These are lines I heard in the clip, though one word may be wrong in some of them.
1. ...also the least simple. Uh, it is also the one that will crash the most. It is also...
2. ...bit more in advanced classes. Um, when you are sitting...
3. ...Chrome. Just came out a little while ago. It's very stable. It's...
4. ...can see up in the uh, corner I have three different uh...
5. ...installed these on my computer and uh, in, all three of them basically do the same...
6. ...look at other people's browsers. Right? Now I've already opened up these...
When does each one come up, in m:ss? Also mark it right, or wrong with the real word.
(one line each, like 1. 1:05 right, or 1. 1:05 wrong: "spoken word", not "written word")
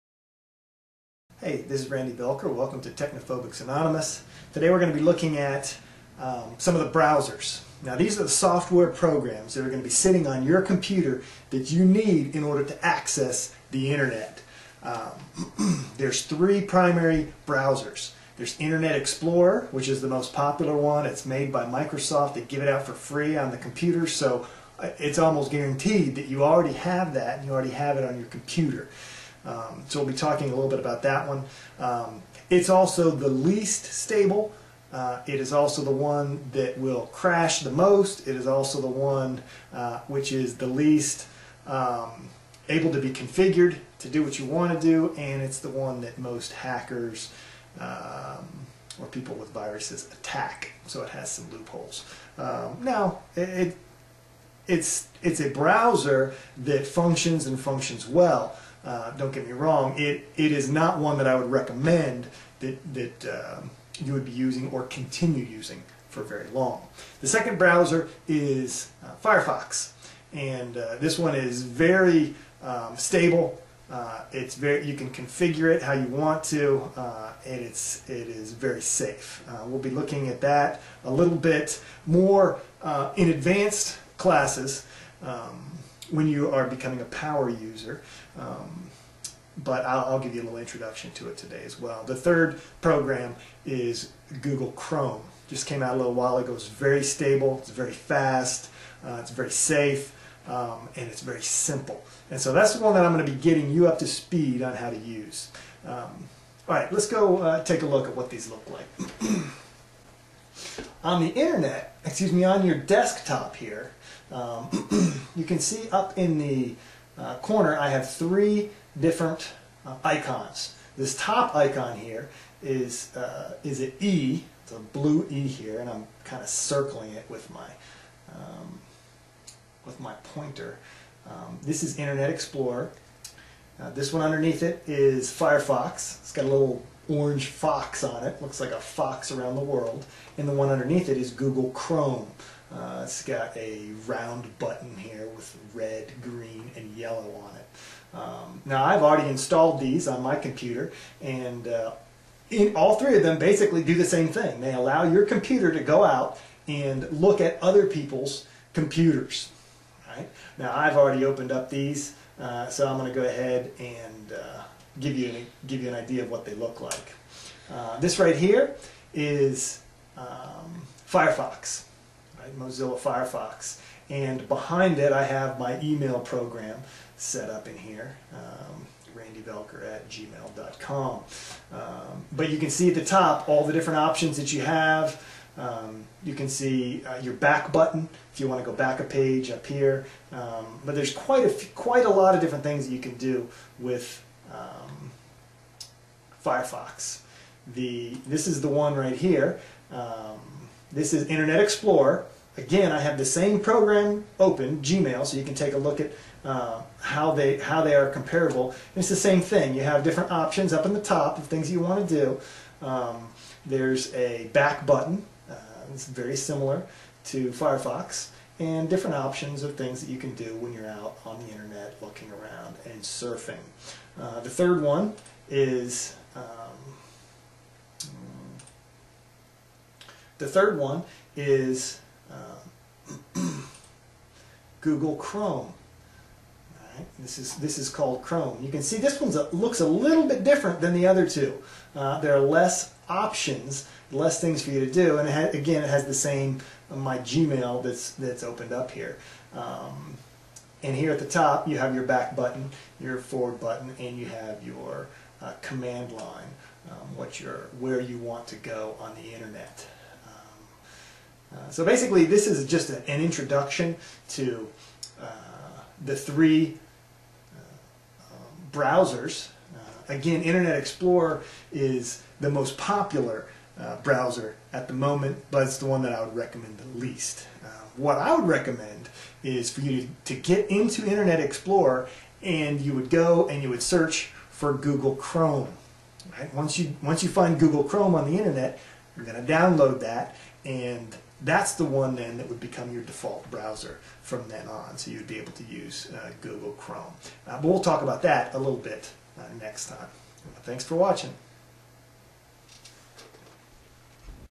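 1. 0:32 wrong: "stable", not "simple"
2. 1:21 wrong: "becoming", not "sitting"
3. 1:34 right
4. 1:55 right
5. 2:29 right
6. 2:37 wrong: "computers", not "browsers".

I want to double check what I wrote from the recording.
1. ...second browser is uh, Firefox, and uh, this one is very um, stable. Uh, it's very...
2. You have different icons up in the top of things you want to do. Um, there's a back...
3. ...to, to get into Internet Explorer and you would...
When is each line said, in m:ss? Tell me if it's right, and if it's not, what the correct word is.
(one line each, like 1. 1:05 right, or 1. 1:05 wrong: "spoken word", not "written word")
1. 1:07 right
2. 3:29 wrong: "options", not "icons"
3. 4:40 right.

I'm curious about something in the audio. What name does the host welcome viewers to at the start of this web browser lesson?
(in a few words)
Technophobics Anonymous.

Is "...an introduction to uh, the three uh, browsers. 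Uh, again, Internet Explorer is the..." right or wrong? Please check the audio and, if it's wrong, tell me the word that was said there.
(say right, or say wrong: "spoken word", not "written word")
right.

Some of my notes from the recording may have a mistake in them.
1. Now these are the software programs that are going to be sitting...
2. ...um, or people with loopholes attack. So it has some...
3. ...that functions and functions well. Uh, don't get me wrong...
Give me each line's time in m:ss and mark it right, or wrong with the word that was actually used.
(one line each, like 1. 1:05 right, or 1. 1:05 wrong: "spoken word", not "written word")
1. 0:07 right
2. 0:47 wrong: "viruses", not "loopholes"
3. 0:56 right.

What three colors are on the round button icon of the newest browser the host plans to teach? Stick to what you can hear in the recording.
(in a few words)
red, green, and yellow.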